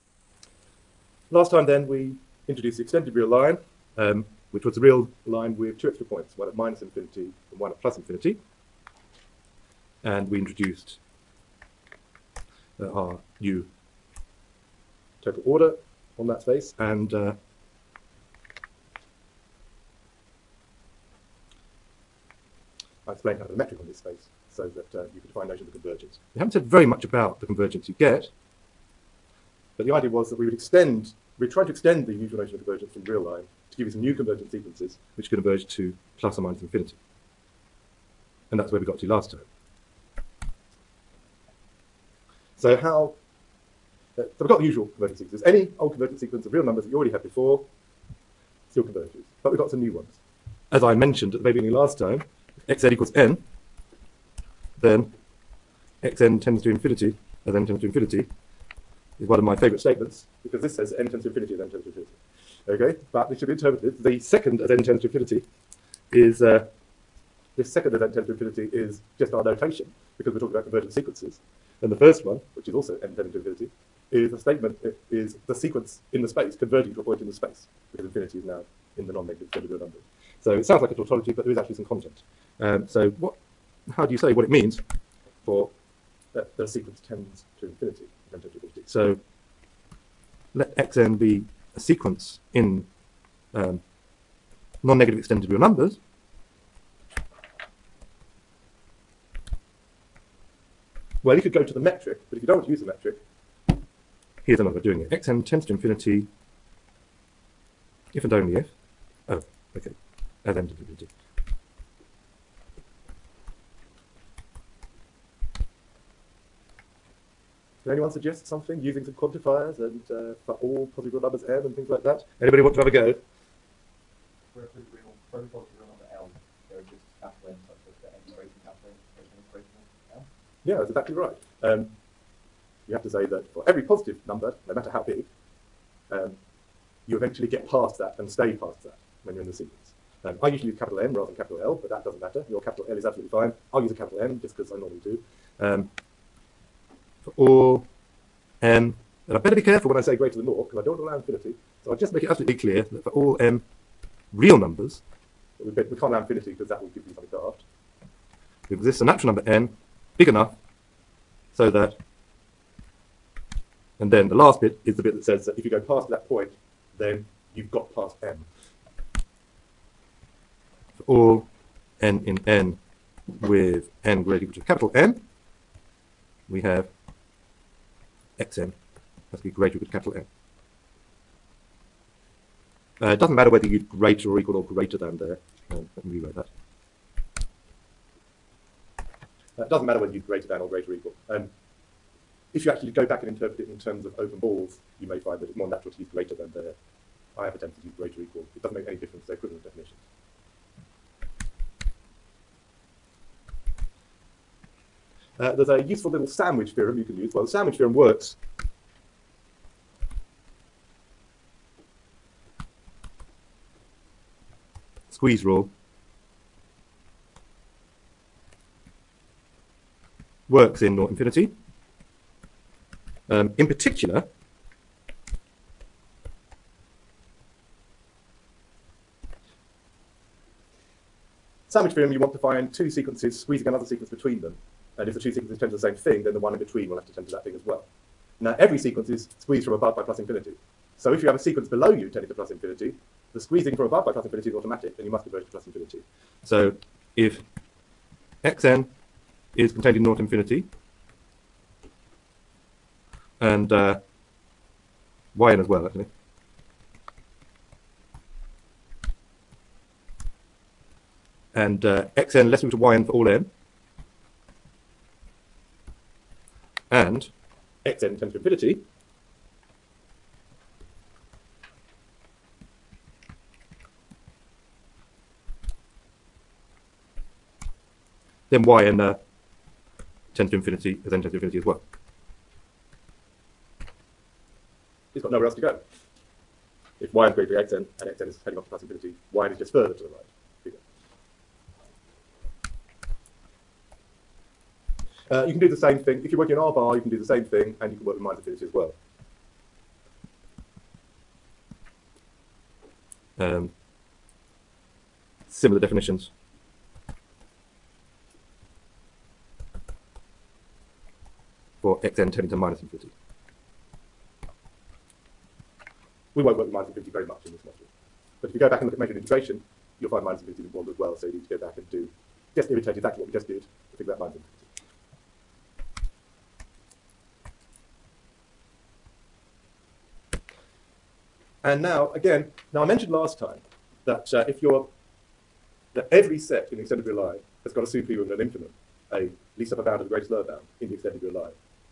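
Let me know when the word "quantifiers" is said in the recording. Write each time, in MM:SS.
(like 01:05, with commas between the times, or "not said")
01:59.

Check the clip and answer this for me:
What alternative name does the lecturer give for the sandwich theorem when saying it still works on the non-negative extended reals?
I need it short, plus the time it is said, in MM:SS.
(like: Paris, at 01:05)
squeeze rule, at 03:35.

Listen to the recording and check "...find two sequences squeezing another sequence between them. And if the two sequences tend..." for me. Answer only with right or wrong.
right.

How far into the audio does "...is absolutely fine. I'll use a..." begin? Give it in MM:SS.
02:22.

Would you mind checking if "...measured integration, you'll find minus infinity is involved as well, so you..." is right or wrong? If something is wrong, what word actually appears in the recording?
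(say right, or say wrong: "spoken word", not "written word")
right.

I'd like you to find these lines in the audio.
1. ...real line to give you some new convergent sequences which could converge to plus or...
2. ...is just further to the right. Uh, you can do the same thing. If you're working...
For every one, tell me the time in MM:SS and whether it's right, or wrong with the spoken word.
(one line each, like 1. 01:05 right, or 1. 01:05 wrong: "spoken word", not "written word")
1. 00:33 right
2. 04:49 right.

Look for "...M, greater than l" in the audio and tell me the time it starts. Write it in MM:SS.
02:08.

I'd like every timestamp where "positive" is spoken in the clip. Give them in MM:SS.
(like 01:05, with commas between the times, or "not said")
02:00, 02:05, 02:13.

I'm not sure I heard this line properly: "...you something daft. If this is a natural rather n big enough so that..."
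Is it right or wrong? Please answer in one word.
wrong.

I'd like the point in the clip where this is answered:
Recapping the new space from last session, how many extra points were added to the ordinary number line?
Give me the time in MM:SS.
00:05.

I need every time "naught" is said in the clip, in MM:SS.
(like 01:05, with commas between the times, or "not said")
03:40, 04:10.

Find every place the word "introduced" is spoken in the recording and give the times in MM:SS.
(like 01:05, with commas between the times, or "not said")
00:02, 00:10.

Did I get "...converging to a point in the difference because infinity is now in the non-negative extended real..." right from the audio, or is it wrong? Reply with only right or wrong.
wrong.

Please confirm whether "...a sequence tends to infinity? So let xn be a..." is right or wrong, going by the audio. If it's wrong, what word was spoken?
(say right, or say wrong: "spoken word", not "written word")
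right.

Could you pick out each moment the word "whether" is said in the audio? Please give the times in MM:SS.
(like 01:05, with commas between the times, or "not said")
03:03, 03:09.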